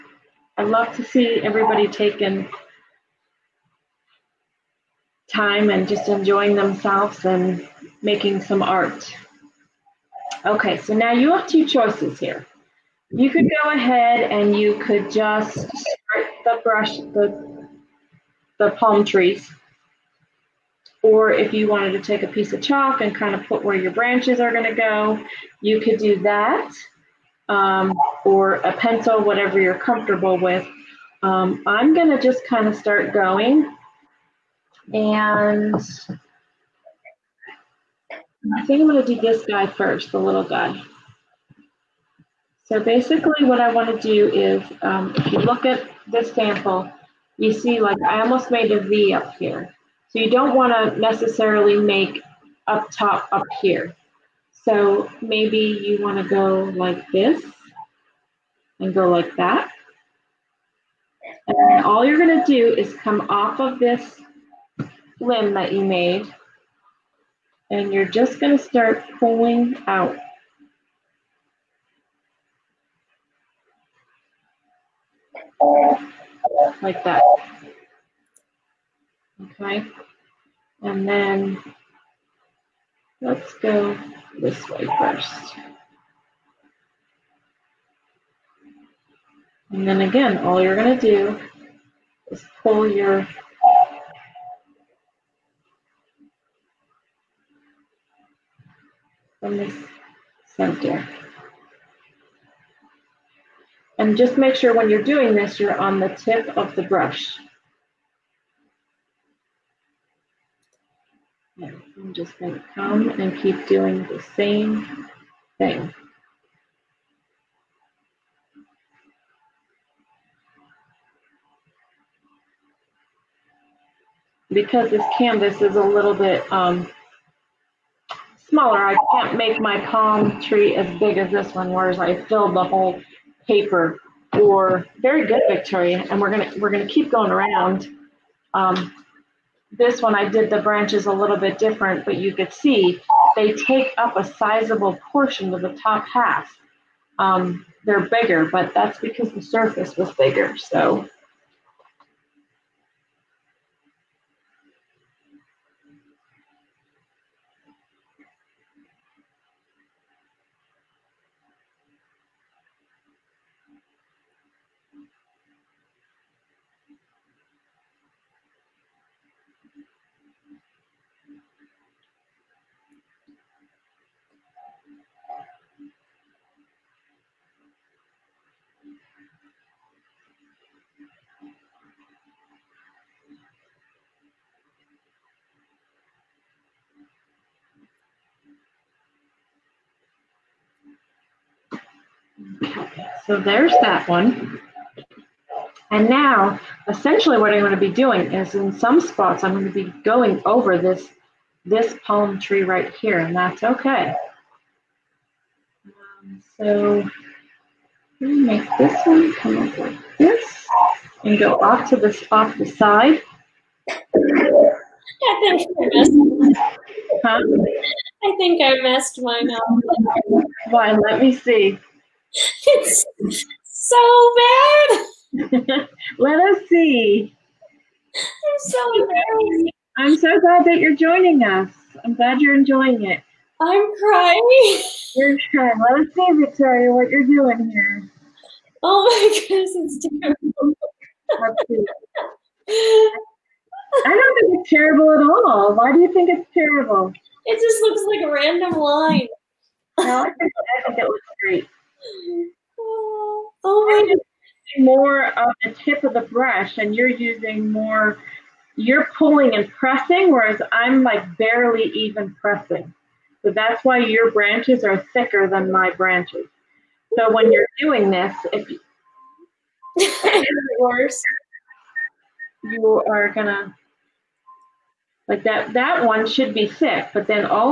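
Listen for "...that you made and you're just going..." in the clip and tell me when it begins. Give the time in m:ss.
1:05.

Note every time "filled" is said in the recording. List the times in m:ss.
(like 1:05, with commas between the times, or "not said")
2:12.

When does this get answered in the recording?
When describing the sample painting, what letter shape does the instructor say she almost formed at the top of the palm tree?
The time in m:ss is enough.
0:48.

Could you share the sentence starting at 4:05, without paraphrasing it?
Why do you think it's terrible?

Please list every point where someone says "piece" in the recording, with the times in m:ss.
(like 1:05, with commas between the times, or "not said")
0:22.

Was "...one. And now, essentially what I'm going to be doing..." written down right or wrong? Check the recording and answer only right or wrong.
right.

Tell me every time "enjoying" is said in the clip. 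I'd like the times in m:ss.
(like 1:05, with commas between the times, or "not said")
0:06, 3:52.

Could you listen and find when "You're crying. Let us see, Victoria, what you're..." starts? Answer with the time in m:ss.
3:55.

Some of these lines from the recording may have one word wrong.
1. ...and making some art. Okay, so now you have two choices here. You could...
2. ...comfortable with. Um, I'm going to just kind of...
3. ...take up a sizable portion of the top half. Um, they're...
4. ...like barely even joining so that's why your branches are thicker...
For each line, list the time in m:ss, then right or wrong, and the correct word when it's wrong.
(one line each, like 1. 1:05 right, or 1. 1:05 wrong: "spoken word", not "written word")
1. 0:07 right
2. 0:29 right
3. 2:23 right
4. 4:21 wrong: "pressing", not "joining".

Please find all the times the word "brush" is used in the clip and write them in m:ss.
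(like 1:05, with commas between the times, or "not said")
0:16, 1:46, 4:16.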